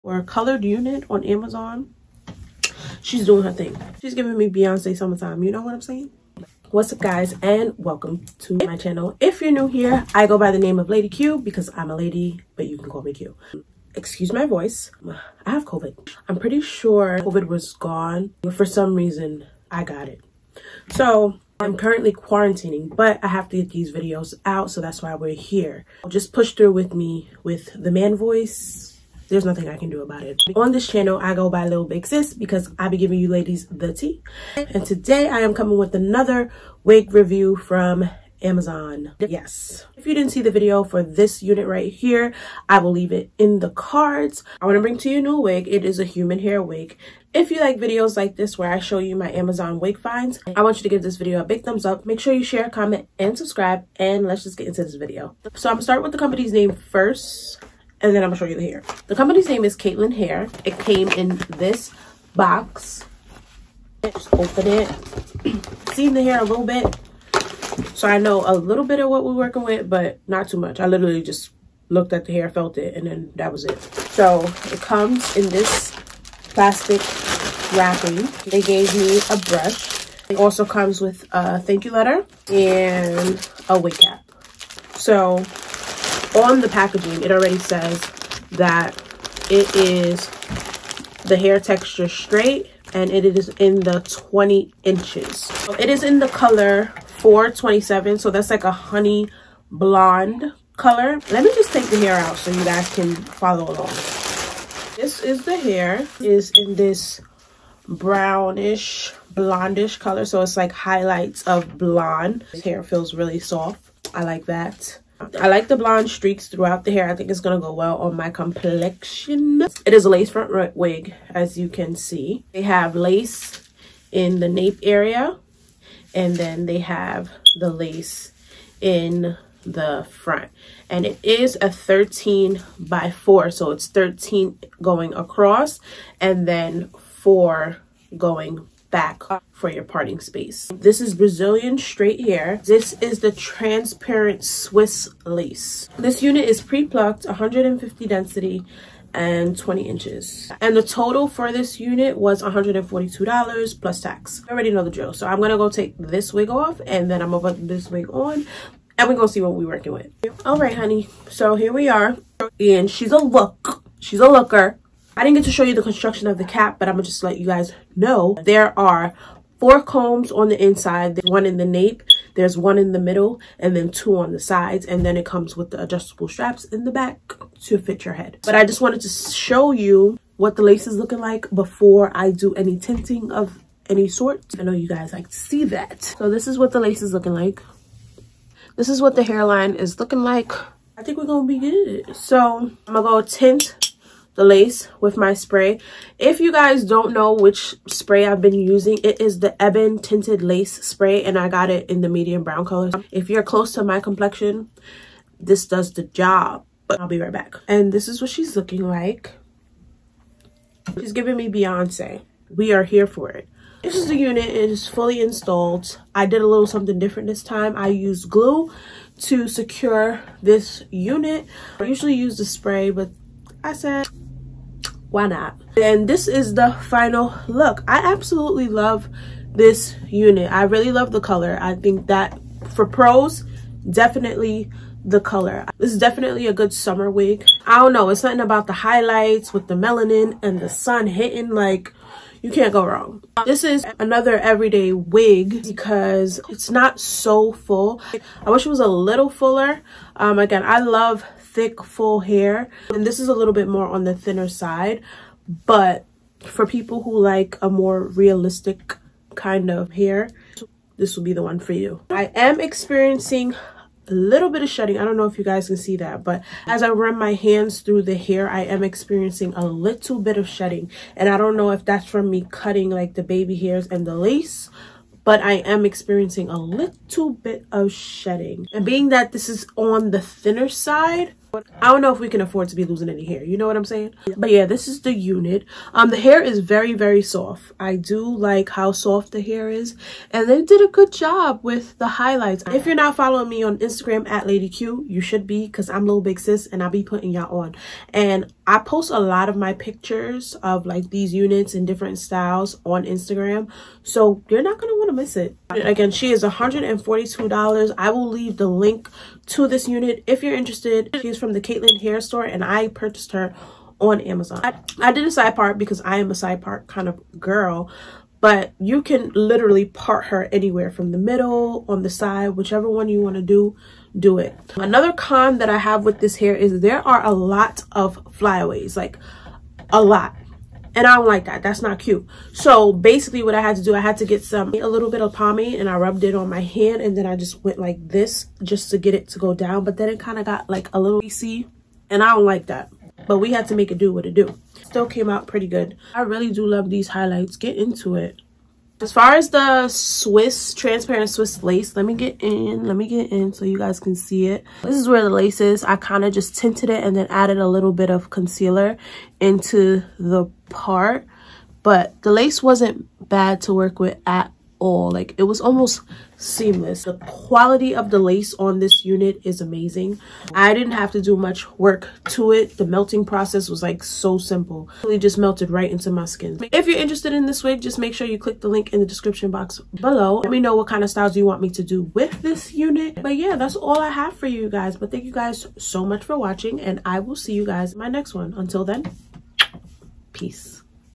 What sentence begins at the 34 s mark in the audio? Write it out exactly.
And today I am coming with another wig review from Amazon.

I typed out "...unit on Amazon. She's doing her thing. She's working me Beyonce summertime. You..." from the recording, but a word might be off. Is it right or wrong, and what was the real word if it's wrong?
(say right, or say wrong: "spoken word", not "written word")
wrong: "giving", not "working".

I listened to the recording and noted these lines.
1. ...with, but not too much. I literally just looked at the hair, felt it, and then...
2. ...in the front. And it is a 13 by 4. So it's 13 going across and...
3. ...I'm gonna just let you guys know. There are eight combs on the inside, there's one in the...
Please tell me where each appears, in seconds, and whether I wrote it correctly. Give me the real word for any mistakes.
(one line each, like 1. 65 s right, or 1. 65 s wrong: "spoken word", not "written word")
1. 69 s right
2. 128 s right
3. 166 s wrong: "four", not "eight".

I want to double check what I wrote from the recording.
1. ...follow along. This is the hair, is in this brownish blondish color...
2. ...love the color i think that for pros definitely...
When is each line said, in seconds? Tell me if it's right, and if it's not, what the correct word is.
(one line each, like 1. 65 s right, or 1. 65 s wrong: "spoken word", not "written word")
1. 103 s right
2. 230 s right.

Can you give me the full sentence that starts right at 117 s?
I think it's going to go well on my complexion.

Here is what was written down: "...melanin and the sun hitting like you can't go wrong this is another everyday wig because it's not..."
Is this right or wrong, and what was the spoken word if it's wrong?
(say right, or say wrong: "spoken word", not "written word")
right.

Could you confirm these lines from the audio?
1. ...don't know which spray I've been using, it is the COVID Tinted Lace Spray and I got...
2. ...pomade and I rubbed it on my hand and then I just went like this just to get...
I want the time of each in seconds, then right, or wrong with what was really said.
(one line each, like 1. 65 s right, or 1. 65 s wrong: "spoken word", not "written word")
1. 196 s wrong: "Ebin", not "COVID"
2. 335 s right.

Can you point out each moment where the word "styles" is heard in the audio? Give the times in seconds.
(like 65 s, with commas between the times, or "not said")
302 s, 381 s.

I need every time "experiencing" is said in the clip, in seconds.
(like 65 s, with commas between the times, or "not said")
262 s, 268 s, 275 s.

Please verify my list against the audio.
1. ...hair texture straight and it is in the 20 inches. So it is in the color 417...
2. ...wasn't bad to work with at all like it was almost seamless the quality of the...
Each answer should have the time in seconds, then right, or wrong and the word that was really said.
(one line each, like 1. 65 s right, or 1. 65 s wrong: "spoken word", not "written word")
1. 91 s wrong: "427", not "417"
2. 362 s right.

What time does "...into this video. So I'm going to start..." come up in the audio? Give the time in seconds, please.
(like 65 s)
54 s.